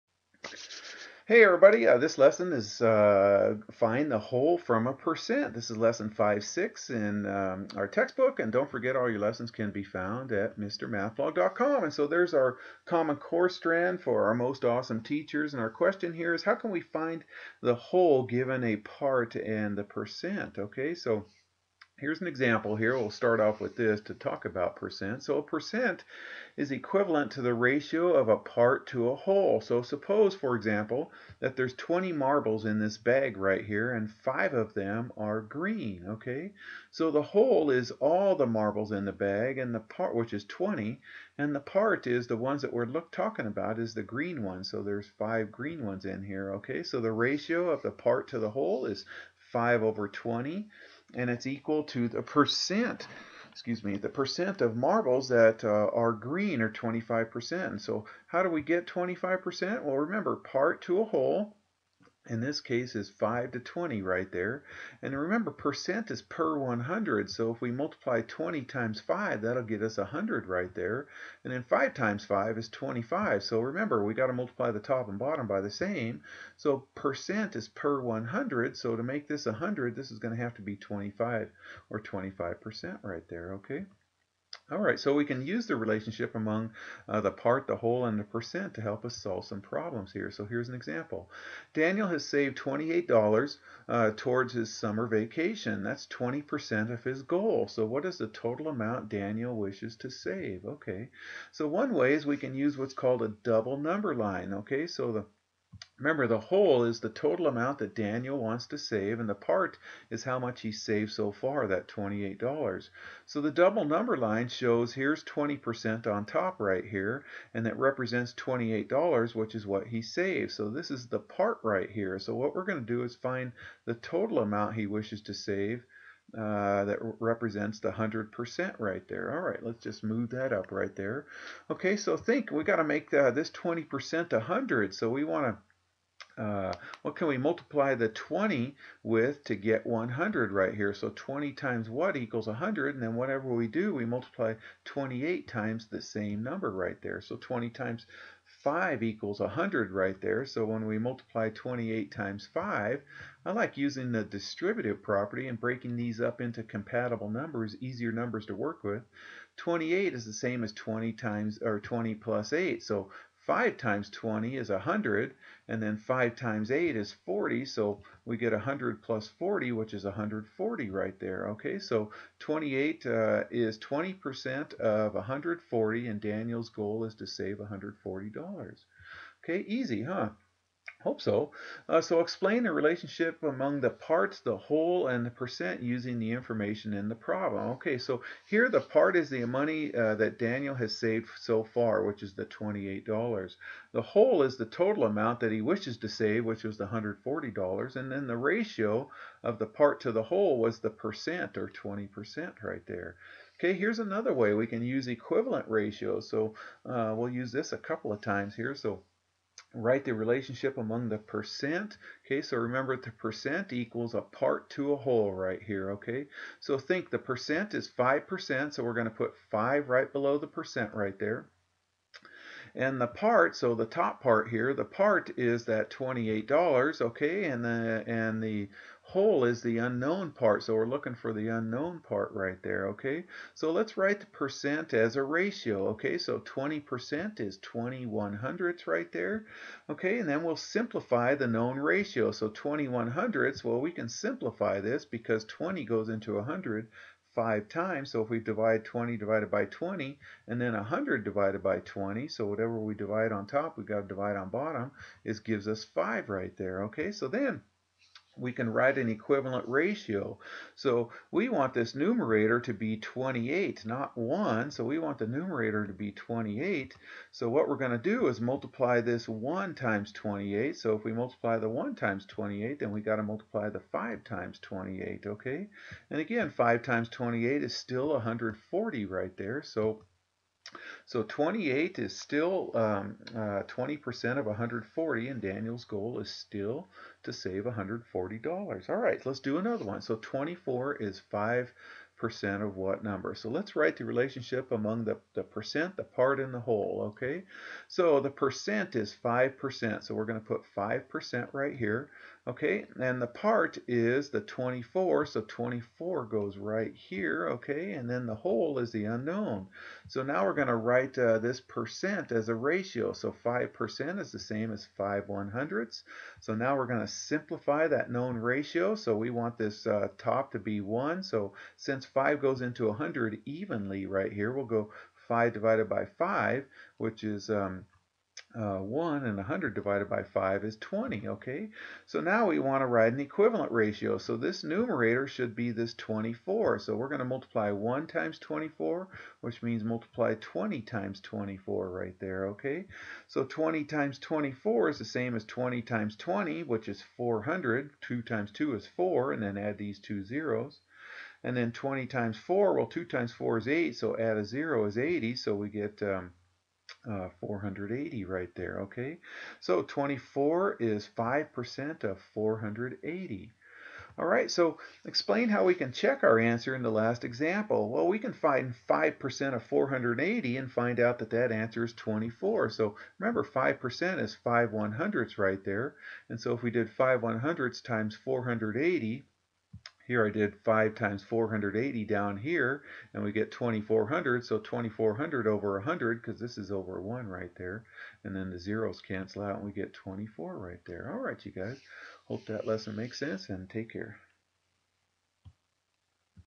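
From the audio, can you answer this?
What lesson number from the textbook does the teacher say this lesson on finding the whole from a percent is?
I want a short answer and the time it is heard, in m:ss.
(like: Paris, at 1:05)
5-6, at 0:05.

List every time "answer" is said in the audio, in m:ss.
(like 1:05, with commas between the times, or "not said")
6:06, 6:11.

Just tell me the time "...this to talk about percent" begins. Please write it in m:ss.
0:23.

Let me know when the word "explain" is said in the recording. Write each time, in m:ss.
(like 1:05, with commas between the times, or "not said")
3:02, 6:05.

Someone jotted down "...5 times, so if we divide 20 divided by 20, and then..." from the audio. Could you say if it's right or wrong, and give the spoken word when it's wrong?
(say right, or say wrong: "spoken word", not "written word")
right.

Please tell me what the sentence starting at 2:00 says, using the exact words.
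So this is the part right here.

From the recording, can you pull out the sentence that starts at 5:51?
And then 20 times 4, well, 2 times 4 is 8, so add a 0 is 80, so we get...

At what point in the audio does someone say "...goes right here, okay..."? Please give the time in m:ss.
5:06.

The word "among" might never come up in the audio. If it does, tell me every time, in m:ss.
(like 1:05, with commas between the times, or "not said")
1:26, 3:03, 3:30, 4:54.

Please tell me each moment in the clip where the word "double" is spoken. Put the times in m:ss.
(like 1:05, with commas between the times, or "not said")
1:43, 1:53.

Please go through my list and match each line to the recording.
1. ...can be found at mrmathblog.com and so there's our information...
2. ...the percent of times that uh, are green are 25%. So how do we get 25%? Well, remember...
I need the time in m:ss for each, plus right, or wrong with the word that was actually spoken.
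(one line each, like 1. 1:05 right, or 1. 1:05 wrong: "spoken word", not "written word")
1. 0:09 wrong: "common", not "information"
2. 0:53 wrong: "marbles", not "times".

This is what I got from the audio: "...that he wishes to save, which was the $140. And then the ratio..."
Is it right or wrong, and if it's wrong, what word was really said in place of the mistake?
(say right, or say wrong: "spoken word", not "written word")
right.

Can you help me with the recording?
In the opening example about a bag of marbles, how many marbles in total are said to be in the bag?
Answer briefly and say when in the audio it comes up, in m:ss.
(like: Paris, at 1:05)
20, at 0:31.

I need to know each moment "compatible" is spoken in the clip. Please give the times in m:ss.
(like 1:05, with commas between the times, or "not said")
2:36.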